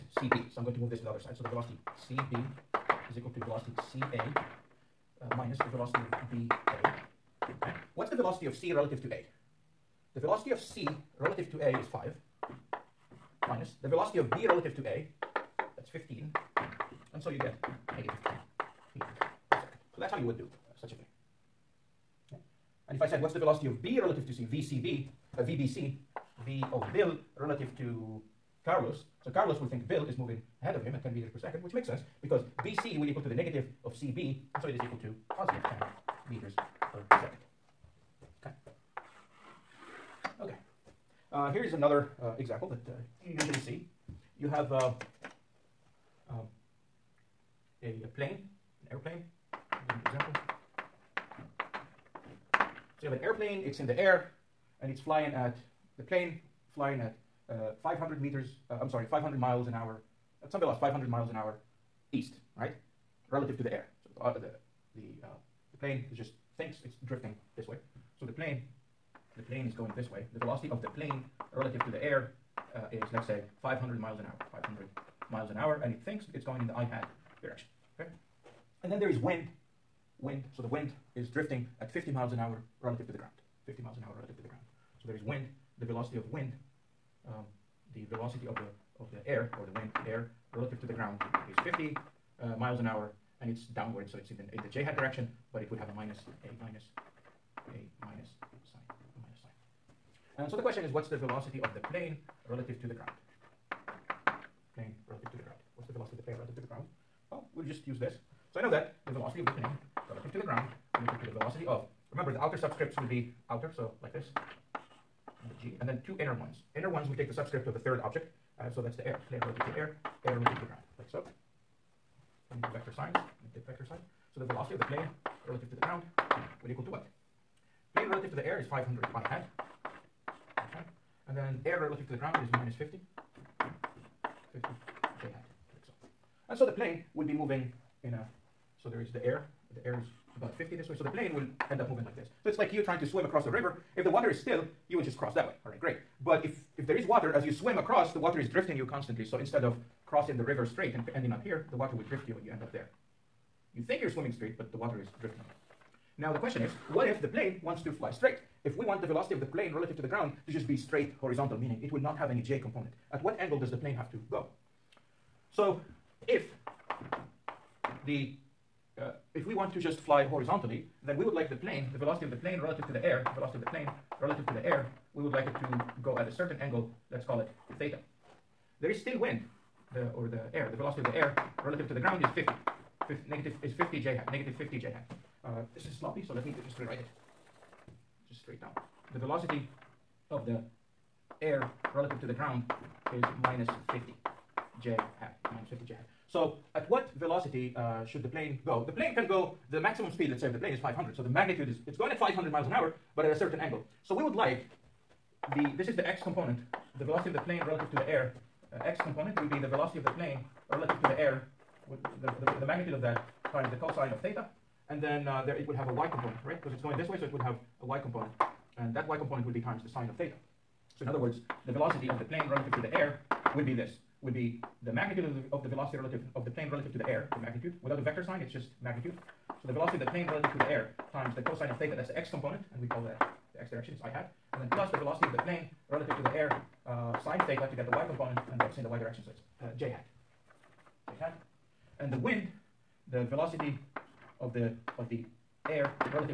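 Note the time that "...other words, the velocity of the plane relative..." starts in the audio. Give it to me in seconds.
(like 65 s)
221 s.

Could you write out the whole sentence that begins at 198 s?
The plane can go, the maximum speed, let's say, of the plane is 500.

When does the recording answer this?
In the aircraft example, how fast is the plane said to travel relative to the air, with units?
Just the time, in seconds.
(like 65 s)
60 s.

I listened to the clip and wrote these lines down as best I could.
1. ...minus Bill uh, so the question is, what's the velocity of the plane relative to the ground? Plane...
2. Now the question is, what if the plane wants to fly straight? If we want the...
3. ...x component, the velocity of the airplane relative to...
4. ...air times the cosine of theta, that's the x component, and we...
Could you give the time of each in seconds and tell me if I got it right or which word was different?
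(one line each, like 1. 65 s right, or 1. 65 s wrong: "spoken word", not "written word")
1. 98 s wrong: "And", not "Bill"
2. 156 s right
3. 206 s wrong: "plane", not "airplane"
4. 230 s right.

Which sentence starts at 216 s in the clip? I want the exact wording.
Because it's going this way, so it would have a y component.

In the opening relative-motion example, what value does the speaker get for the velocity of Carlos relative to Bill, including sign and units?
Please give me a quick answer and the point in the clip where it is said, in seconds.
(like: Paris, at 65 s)
-10 m/s, at 17 s.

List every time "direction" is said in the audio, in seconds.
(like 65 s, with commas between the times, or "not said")
77 s, 94 s, 233 s, 238 s.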